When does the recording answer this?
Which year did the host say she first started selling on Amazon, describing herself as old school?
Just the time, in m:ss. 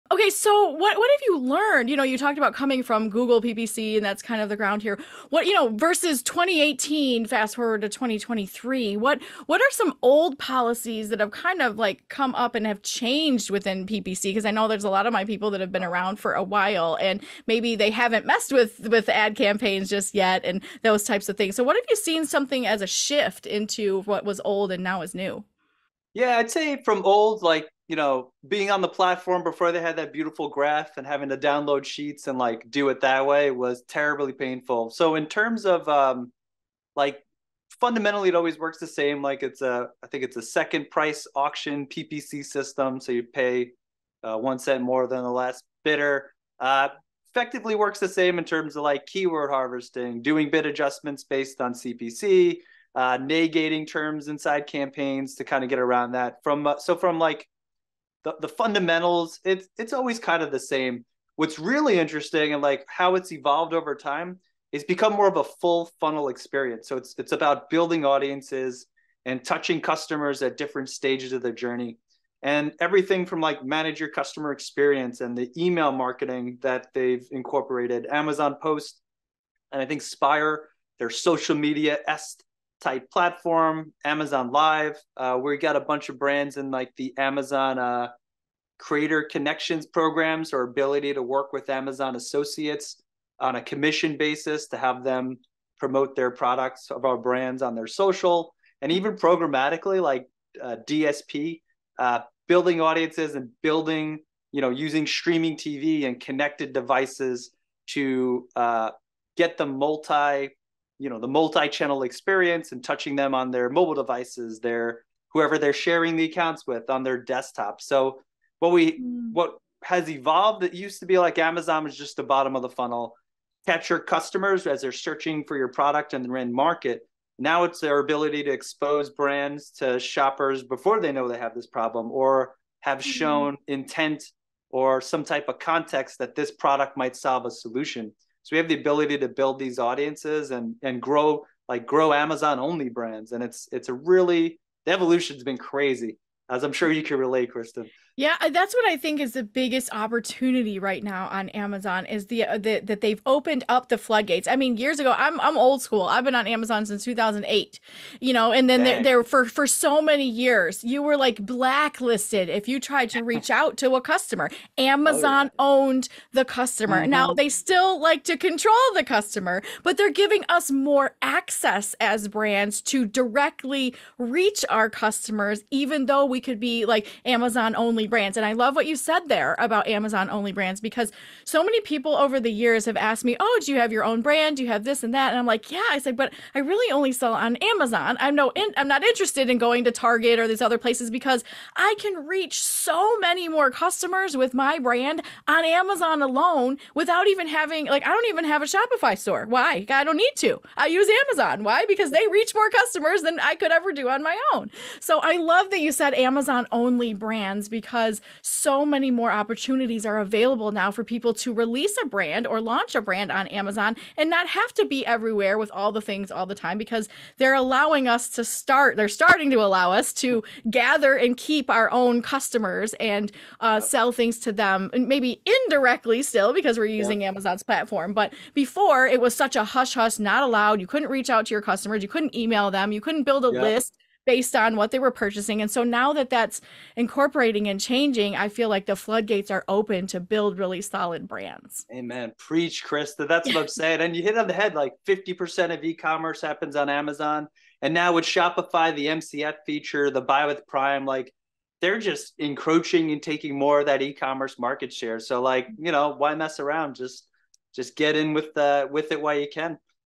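2:37.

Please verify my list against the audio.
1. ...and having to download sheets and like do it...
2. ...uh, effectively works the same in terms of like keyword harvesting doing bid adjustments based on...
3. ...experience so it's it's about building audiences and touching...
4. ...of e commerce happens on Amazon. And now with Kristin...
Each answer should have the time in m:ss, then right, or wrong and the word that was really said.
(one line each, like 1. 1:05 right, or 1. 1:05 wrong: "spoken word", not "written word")
1. 0:30 right
2. 0:46 right
3. 1:06 right
4. 4:05 wrong: "Shopify", not "Kristin".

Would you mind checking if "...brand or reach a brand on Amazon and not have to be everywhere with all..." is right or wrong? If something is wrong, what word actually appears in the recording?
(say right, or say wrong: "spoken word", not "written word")
wrong: "launch", not "reach".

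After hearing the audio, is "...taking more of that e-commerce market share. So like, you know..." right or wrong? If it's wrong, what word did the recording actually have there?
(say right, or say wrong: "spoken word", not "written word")
right.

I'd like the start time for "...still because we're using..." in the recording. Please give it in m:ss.
3:46.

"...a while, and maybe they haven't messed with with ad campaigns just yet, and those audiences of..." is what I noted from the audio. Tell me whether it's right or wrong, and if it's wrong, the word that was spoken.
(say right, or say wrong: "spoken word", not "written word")
wrong: "types", not "audiences".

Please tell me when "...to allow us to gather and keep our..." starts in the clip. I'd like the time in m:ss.
3:39.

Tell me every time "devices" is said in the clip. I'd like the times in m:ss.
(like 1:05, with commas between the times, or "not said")
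1:46, 1:53.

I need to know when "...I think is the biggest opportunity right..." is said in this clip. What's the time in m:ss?
2:28.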